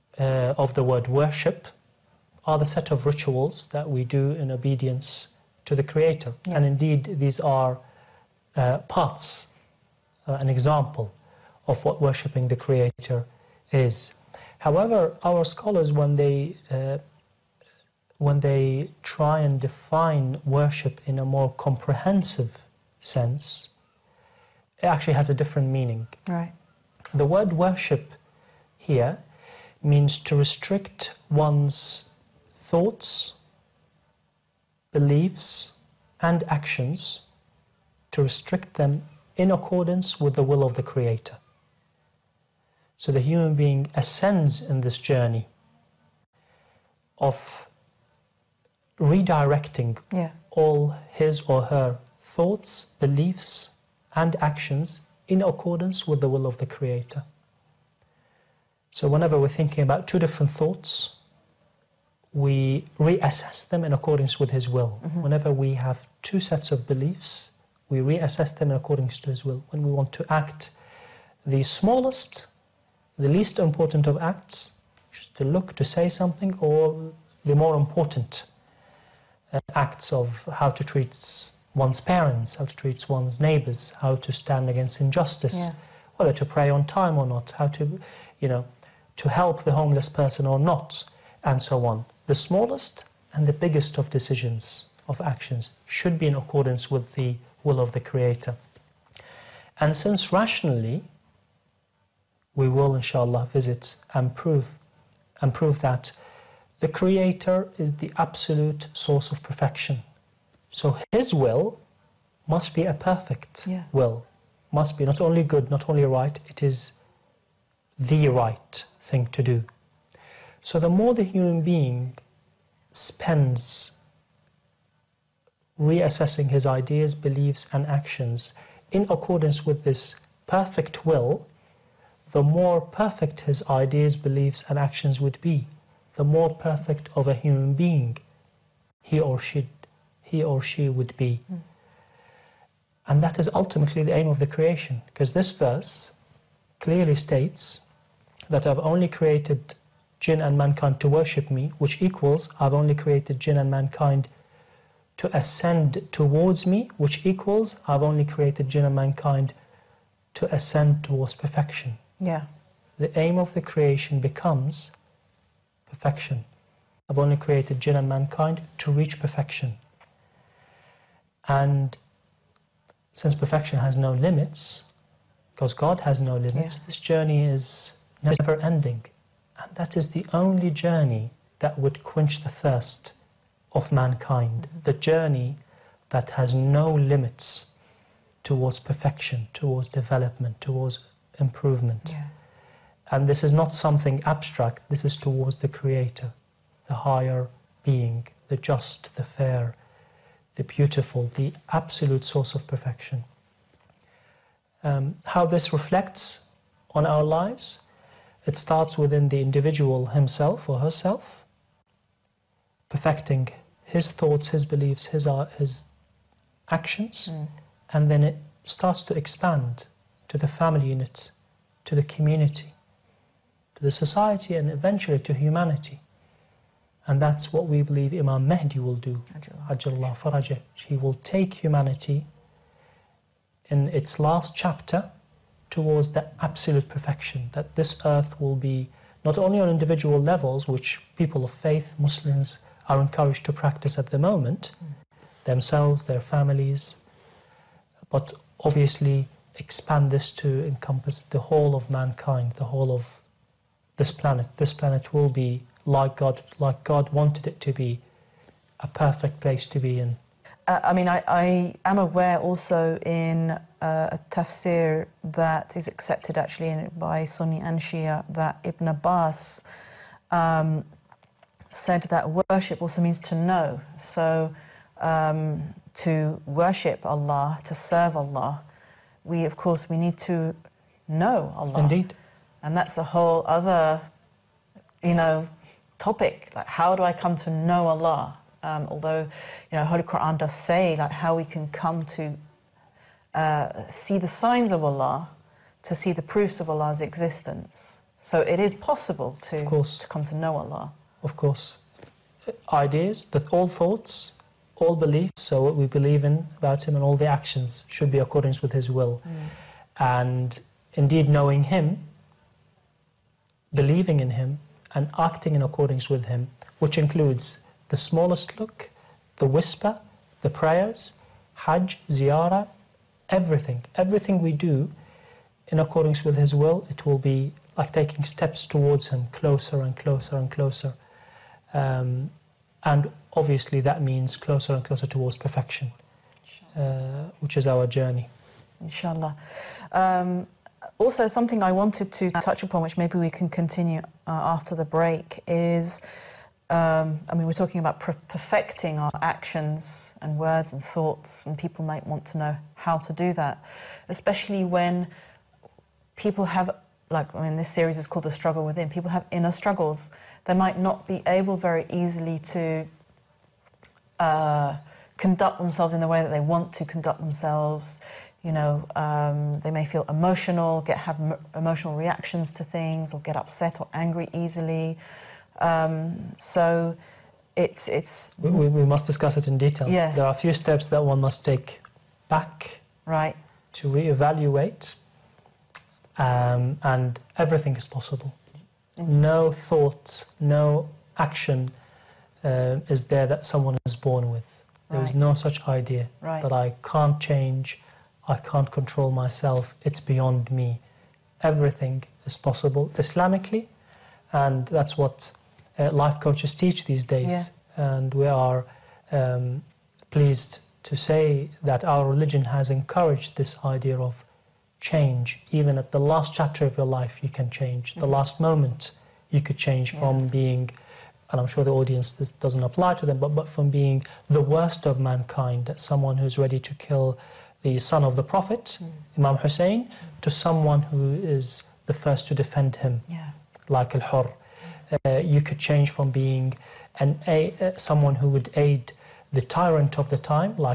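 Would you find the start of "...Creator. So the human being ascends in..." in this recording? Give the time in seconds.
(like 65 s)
40 s.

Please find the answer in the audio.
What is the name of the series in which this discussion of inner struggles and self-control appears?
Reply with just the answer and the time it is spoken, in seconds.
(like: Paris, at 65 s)
The Struggle Within, at 358 s.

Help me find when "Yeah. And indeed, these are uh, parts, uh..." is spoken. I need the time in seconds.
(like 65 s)
6 s.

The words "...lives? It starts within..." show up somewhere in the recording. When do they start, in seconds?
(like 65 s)
207 s.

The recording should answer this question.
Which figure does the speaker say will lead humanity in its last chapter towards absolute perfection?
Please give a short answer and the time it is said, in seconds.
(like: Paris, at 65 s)
Imam Mahdi, at 228 s.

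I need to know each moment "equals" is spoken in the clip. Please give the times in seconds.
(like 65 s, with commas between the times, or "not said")
152 s, 157 s.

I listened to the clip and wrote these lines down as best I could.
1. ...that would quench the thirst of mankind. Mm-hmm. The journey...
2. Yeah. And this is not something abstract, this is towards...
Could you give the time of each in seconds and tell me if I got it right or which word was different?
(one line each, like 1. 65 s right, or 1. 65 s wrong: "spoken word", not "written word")
1. 181 s right
2. 192 s right.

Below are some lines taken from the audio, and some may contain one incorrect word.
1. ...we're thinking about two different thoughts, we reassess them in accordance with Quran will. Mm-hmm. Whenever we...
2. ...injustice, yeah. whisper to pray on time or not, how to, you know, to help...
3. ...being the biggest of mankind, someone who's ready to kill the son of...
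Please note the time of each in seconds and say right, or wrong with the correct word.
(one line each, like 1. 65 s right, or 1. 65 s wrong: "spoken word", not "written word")
1. 59 s wrong: "His", not "Quran"
2. 84 s wrong: "whether", not "whisper"
3. 423 s wrong: "worst", not "biggest".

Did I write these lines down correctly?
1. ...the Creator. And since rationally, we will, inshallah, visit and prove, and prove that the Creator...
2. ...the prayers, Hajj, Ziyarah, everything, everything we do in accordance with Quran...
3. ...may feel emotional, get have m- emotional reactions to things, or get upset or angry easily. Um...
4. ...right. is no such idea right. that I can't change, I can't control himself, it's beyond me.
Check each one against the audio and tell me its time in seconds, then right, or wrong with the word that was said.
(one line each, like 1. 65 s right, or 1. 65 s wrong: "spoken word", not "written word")
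1. 97 s right
2. 320 s wrong: "His", not "Quran"
3. 369 s right
4. 394 s wrong: "myself", not "himself".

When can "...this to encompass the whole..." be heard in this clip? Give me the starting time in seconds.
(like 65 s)
250 s.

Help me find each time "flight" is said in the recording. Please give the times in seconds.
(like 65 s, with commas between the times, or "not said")
not said.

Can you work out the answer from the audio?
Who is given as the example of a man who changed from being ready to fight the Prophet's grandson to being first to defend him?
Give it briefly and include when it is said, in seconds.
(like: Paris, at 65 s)
Al Hur, at 433 s.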